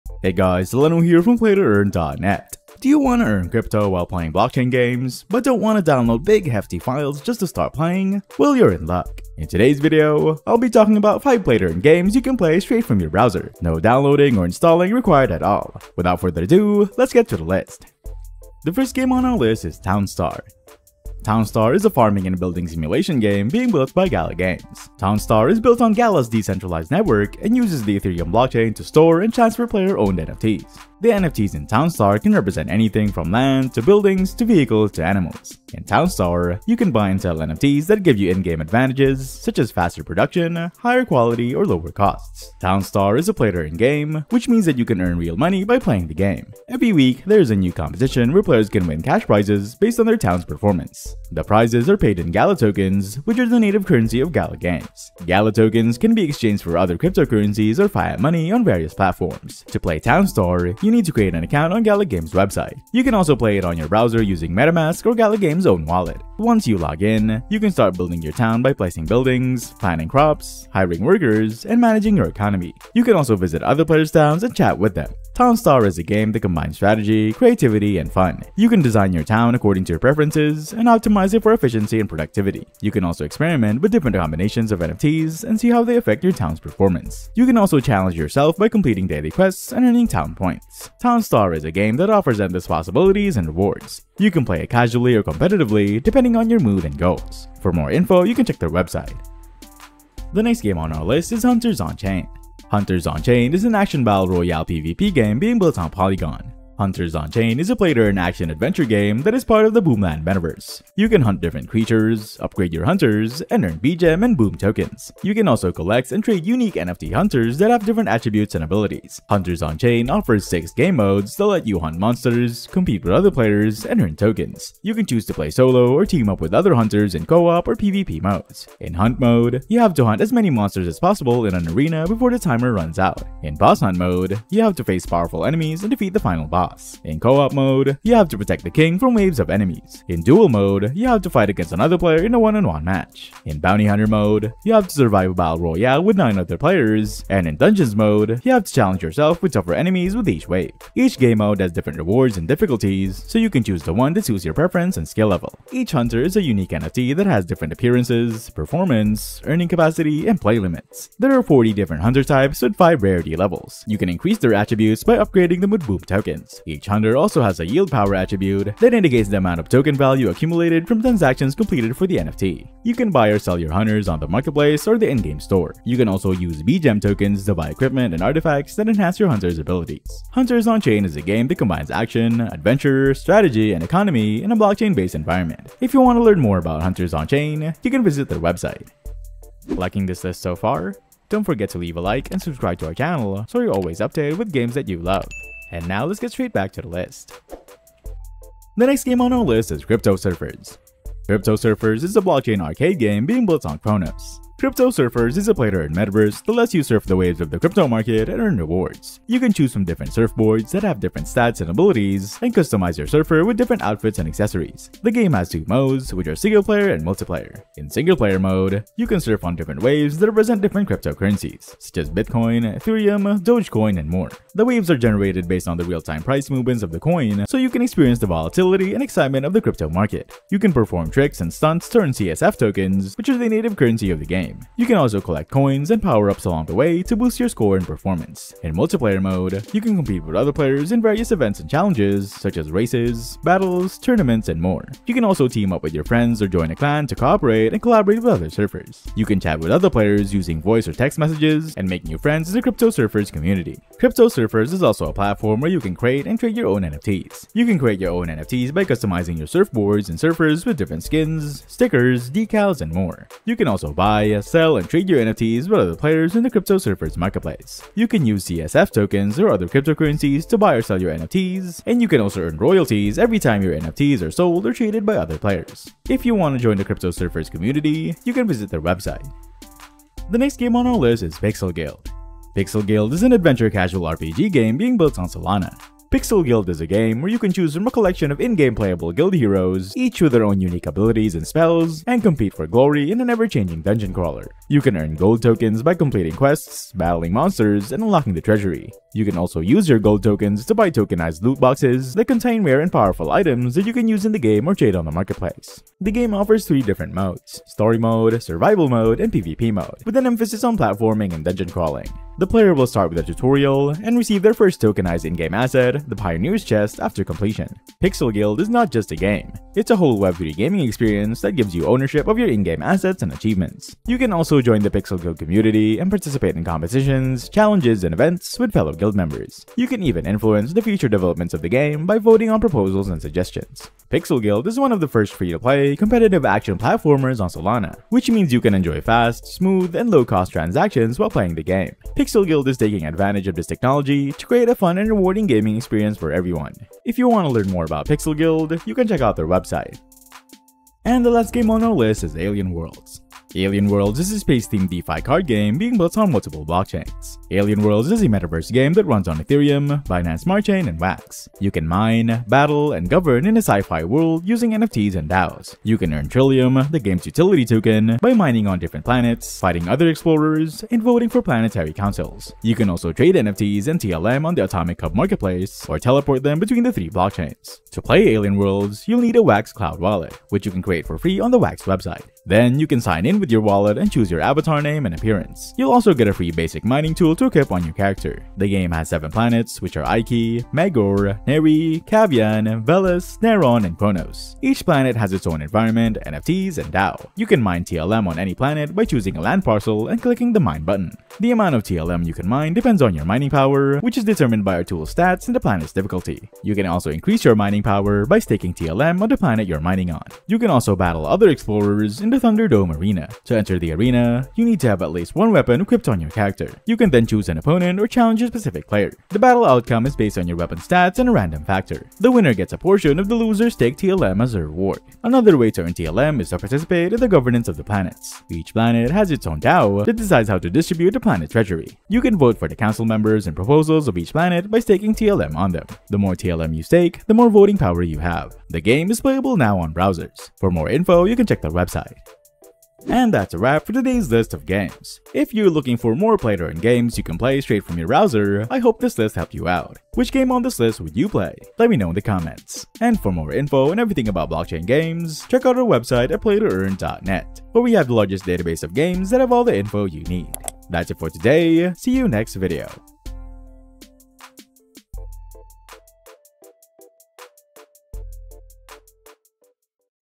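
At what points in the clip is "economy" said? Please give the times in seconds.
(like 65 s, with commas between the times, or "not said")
72 s, 183 s.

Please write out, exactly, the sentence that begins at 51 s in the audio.
The prizes are paid in Gala tokens, which are the native currency of Gala Games.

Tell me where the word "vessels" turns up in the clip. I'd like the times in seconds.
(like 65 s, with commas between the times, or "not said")
not said.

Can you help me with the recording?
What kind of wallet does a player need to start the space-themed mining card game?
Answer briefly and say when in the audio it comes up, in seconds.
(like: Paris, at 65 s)
Wax Cloud Wallet, at 379 s.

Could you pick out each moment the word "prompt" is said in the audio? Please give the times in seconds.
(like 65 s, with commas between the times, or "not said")
not said.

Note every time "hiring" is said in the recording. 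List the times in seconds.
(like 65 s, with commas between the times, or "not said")
70 s.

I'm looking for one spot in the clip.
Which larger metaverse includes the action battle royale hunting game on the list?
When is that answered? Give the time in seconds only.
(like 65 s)
109 s.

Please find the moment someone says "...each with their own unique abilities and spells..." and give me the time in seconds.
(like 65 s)
289 s.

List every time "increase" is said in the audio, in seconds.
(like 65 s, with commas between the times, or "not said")
164 s, 407 s.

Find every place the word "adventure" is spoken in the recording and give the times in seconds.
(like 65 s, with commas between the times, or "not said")
108 s, 182 s, 283 s.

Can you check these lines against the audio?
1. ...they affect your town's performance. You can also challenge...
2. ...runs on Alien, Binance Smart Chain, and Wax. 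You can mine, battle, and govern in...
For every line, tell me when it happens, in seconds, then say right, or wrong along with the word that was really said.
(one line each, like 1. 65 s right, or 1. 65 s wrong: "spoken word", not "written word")
1. 85 s right
2. 359 s wrong: "Ethereum", not "Alien".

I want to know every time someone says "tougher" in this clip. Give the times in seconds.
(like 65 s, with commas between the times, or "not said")
149 s.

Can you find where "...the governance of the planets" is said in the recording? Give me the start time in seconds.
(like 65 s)
427 s.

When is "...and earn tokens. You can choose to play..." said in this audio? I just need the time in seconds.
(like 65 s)
123 s.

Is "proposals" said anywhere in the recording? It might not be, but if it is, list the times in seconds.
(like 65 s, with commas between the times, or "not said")
332 s, 433 s.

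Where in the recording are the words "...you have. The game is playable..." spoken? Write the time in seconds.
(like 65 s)
438 s.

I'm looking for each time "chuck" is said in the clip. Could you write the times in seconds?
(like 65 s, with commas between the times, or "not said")
not said.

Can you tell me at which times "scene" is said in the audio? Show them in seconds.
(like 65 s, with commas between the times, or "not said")
not said.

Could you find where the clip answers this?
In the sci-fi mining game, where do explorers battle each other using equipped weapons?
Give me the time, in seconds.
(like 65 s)
412 s.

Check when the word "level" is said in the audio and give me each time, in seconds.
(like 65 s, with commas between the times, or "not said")
155 s, 163 s.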